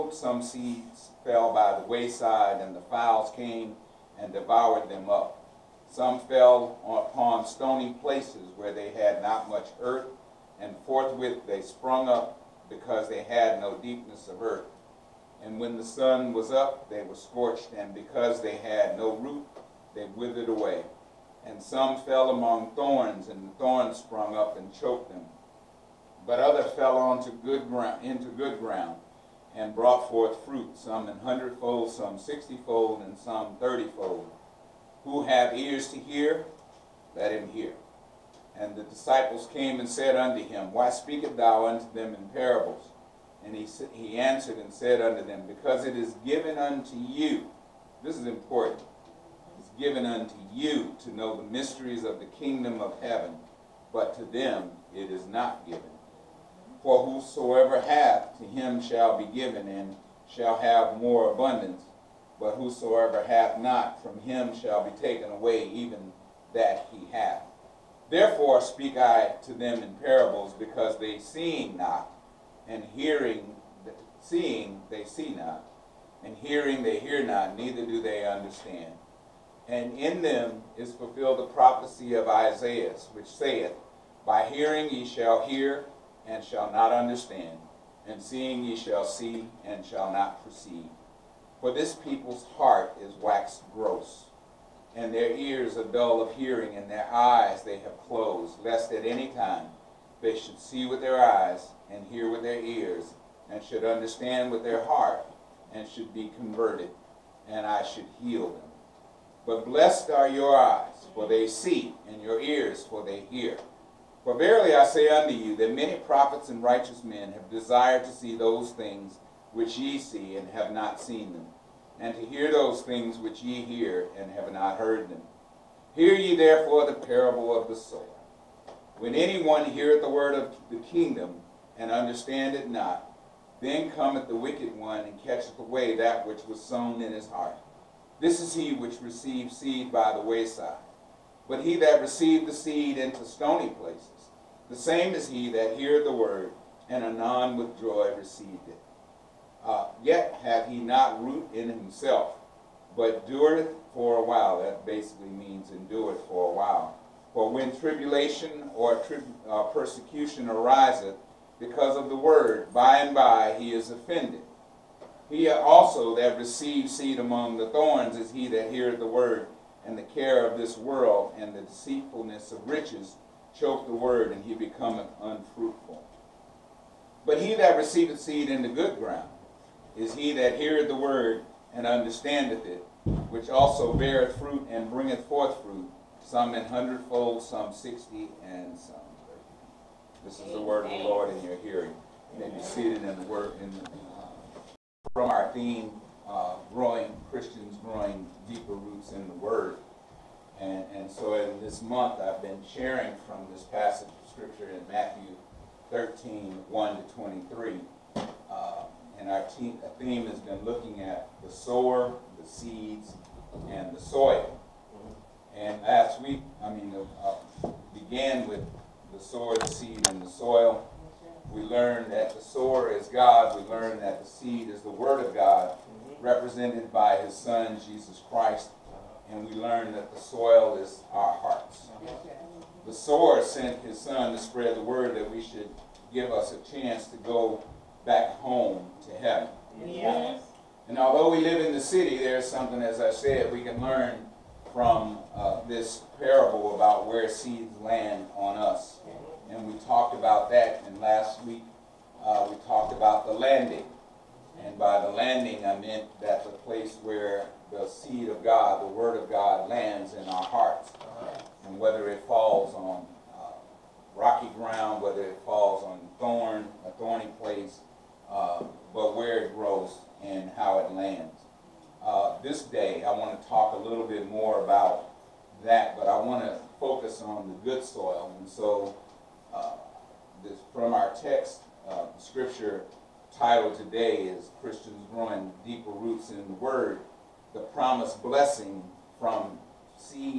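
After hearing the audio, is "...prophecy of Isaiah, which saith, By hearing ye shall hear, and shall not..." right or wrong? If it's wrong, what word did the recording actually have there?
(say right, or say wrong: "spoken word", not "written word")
right.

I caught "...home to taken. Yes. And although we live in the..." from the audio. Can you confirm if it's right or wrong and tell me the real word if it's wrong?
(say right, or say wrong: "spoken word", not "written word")
wrong: "heaven", not "taken".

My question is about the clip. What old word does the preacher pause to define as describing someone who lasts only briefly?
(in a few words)
endureth.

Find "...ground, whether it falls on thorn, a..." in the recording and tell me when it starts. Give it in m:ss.
4:24.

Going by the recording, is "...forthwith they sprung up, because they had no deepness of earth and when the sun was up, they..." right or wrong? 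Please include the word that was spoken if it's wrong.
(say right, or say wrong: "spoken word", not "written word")
right.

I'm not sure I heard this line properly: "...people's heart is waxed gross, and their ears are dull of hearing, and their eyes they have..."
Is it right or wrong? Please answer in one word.
right.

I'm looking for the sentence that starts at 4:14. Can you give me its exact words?
And by the landing, I meant that the place where the seed of God, the word of God, lands in our hearts.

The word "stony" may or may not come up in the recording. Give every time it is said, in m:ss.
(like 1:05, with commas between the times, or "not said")
0:07, 2:23.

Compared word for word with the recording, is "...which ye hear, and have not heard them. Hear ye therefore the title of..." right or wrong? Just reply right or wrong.
wrong.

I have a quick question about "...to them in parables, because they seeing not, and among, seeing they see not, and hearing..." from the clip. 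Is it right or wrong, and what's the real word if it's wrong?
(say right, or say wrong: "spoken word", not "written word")
wrong: "hearing", not "among".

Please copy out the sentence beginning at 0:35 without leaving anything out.
Who have ears to hear, let him hear.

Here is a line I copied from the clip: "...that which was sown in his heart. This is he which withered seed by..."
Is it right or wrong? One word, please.
wrong.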